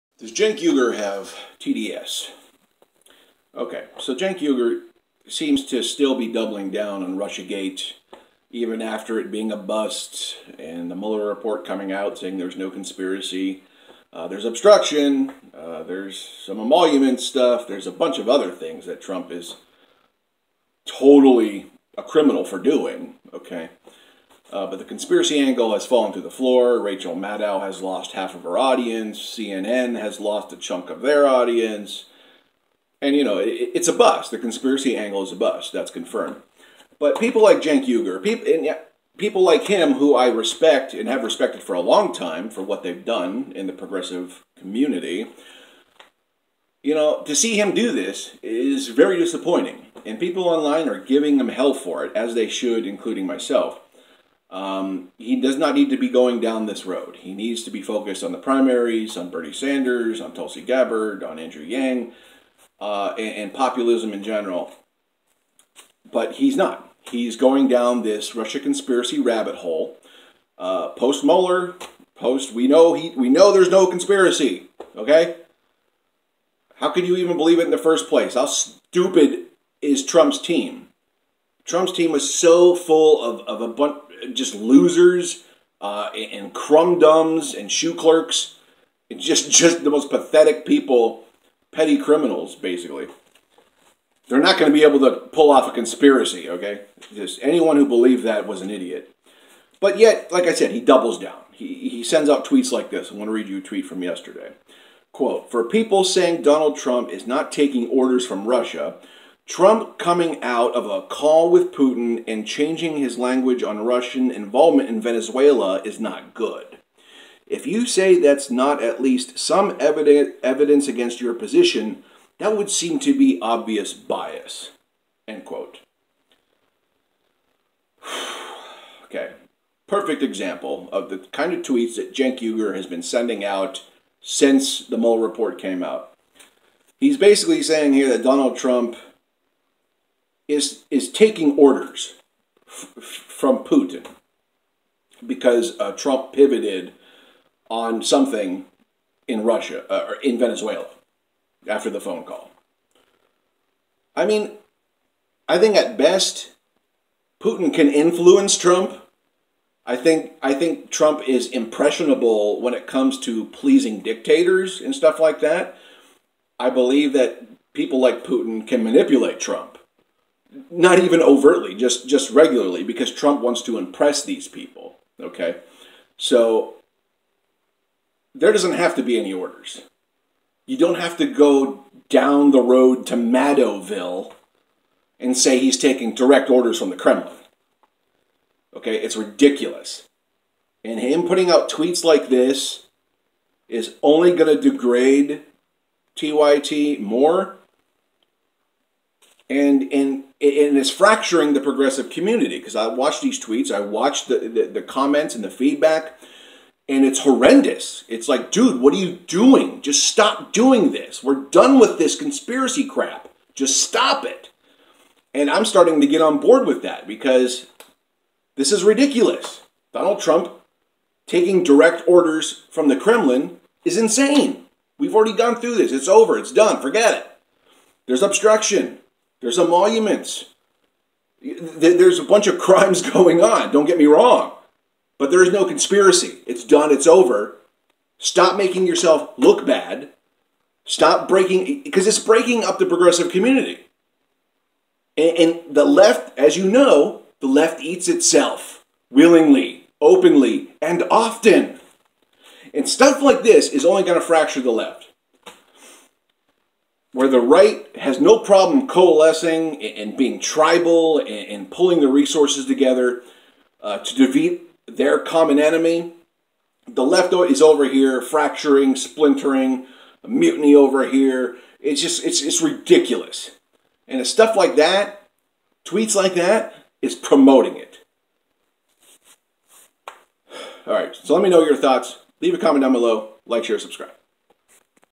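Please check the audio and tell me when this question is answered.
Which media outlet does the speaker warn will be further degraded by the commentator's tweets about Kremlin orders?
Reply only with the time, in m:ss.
3:16.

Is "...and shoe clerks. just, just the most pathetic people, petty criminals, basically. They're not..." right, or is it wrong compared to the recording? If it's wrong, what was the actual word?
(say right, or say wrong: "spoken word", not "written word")
right.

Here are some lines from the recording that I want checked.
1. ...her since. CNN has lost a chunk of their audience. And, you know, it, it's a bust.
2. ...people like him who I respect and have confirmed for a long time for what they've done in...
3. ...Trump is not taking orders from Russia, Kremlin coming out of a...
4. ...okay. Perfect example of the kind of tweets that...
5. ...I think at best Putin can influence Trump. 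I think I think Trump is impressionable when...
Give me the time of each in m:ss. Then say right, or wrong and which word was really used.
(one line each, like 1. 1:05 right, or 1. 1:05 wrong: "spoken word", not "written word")
1. 0:28 wrong: "audience", not "since"
2. 0:39 wrong: "respected", not "confirmed"
3. 1:46 wrong: "Trump", not "Kremlin"
4. 2:09 right
5. 2:35 right.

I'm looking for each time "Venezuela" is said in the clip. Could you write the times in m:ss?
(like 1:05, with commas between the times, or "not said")
1:55, 2:30.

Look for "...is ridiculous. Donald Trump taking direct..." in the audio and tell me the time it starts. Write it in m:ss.
3:38.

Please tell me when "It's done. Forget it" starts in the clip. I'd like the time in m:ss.
3:46.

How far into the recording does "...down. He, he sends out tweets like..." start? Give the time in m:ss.
1:41.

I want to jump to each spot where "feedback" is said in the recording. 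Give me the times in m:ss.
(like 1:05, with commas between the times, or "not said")
3:25.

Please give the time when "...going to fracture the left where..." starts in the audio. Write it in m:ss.
4:14.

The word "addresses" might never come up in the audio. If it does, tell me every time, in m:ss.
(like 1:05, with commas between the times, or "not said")
not said.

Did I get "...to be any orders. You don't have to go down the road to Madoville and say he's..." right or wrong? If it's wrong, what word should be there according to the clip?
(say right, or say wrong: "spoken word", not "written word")
right.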